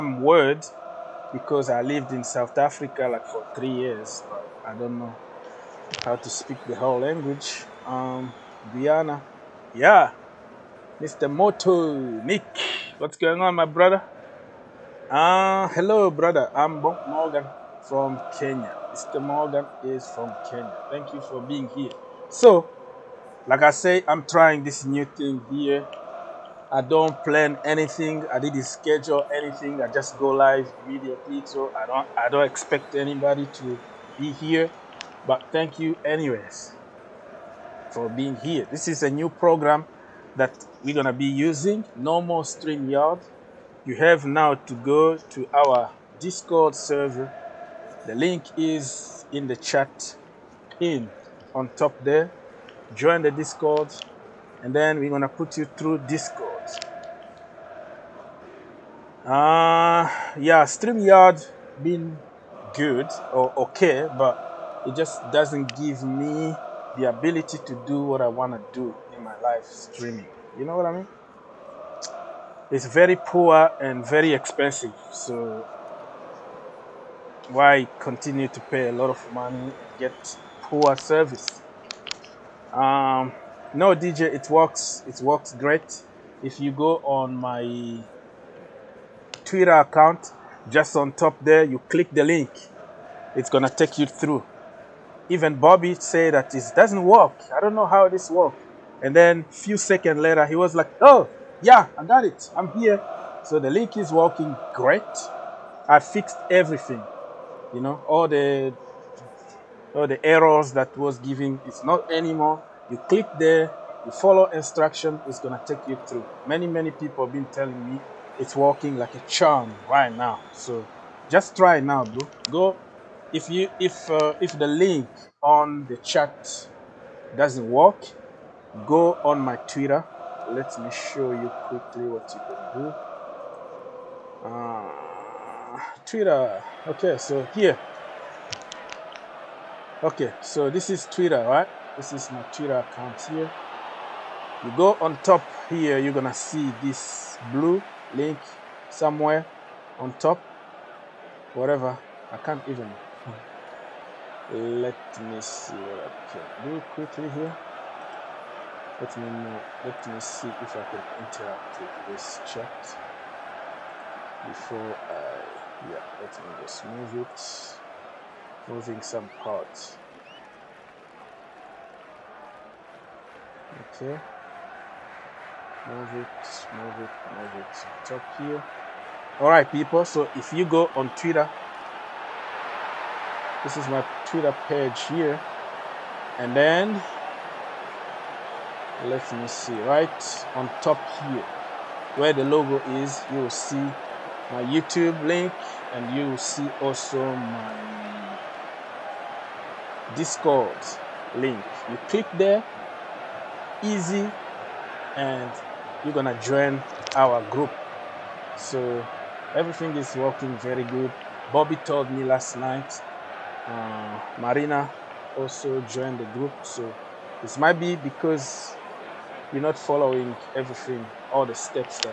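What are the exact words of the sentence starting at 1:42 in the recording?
I'm here." So the link is working great.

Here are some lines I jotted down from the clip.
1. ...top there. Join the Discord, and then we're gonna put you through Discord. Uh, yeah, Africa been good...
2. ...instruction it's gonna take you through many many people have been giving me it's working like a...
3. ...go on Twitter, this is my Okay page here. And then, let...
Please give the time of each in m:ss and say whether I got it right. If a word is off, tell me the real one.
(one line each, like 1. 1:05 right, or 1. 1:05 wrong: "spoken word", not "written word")
1. 0:51 wrong: "StreamYard", not "Africa"
2. 1:54 wrong: "telling", not "giving"
3. 3:00 wrong: "Twitter", not "Okay".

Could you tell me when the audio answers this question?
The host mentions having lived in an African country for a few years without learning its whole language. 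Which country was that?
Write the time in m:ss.
0:02.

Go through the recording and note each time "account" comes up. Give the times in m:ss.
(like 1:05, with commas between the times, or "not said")
1:29, 2:22.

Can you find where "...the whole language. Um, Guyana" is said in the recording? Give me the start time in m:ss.
0:06.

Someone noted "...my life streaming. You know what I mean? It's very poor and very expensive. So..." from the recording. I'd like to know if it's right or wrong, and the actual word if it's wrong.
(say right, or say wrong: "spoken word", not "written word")
right.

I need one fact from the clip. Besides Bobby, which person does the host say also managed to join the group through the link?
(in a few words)
Marina.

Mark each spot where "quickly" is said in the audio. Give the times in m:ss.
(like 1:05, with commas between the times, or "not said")
2:11, 2:36.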